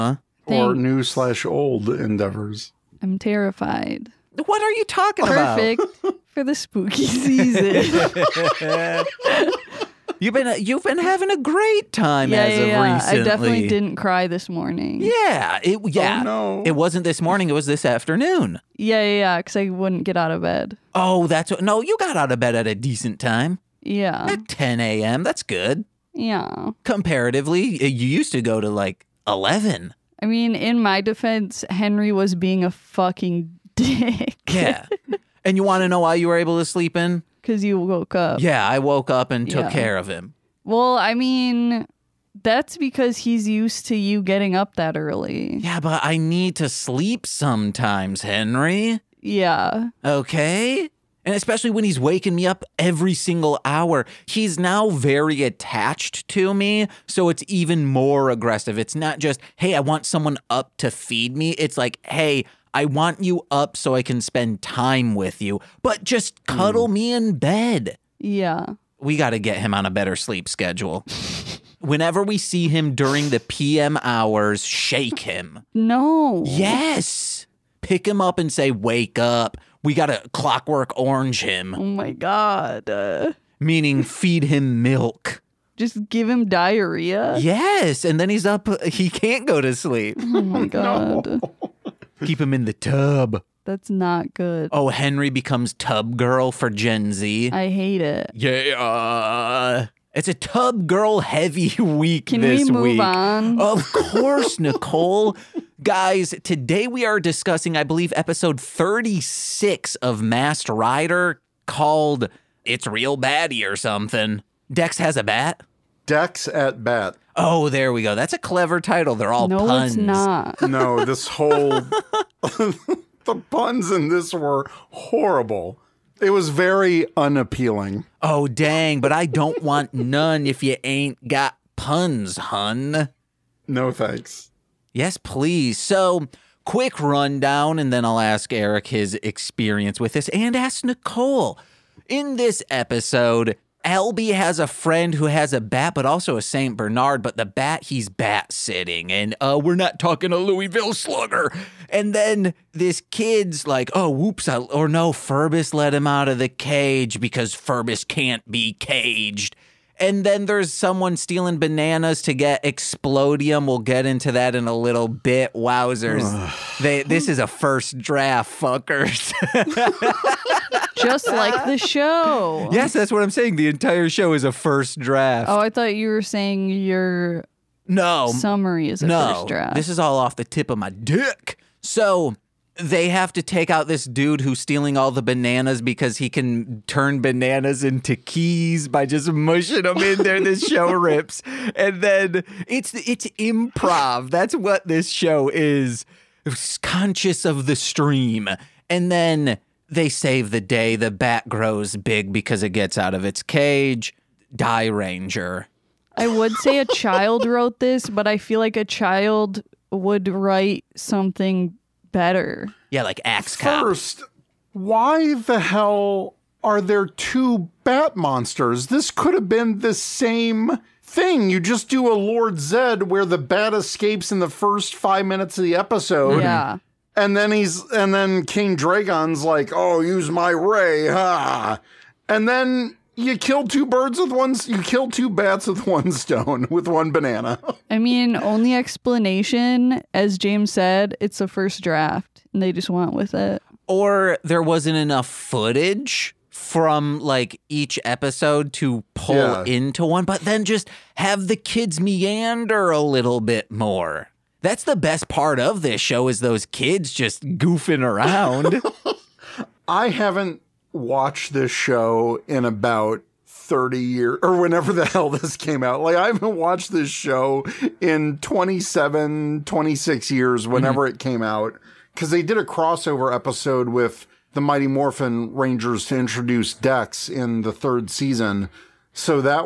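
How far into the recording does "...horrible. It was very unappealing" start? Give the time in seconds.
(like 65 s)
124 s.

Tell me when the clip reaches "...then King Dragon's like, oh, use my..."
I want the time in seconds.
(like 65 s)
228 s.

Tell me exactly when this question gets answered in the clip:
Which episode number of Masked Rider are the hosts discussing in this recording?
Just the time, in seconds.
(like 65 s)
108 s.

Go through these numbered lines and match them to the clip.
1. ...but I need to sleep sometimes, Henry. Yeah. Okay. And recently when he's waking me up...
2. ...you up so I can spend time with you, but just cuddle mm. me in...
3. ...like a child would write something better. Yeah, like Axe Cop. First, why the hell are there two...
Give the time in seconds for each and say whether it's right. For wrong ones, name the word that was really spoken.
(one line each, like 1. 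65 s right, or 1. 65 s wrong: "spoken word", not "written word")
1. 45 s wrong: "especially", not "recently"
2. 63 s right
3. 208 s right.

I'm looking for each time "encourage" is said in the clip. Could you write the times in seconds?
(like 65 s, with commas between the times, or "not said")
not said.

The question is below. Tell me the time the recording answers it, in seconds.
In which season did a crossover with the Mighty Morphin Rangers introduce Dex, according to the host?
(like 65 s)
277 s.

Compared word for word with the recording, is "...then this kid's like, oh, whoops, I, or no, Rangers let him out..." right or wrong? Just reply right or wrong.
wrong.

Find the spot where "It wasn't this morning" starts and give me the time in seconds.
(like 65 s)
16 s.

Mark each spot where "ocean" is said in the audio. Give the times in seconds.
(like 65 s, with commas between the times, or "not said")
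not said.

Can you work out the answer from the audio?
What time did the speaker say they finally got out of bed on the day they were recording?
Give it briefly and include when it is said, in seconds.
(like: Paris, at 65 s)
10 a.m., at 24 s.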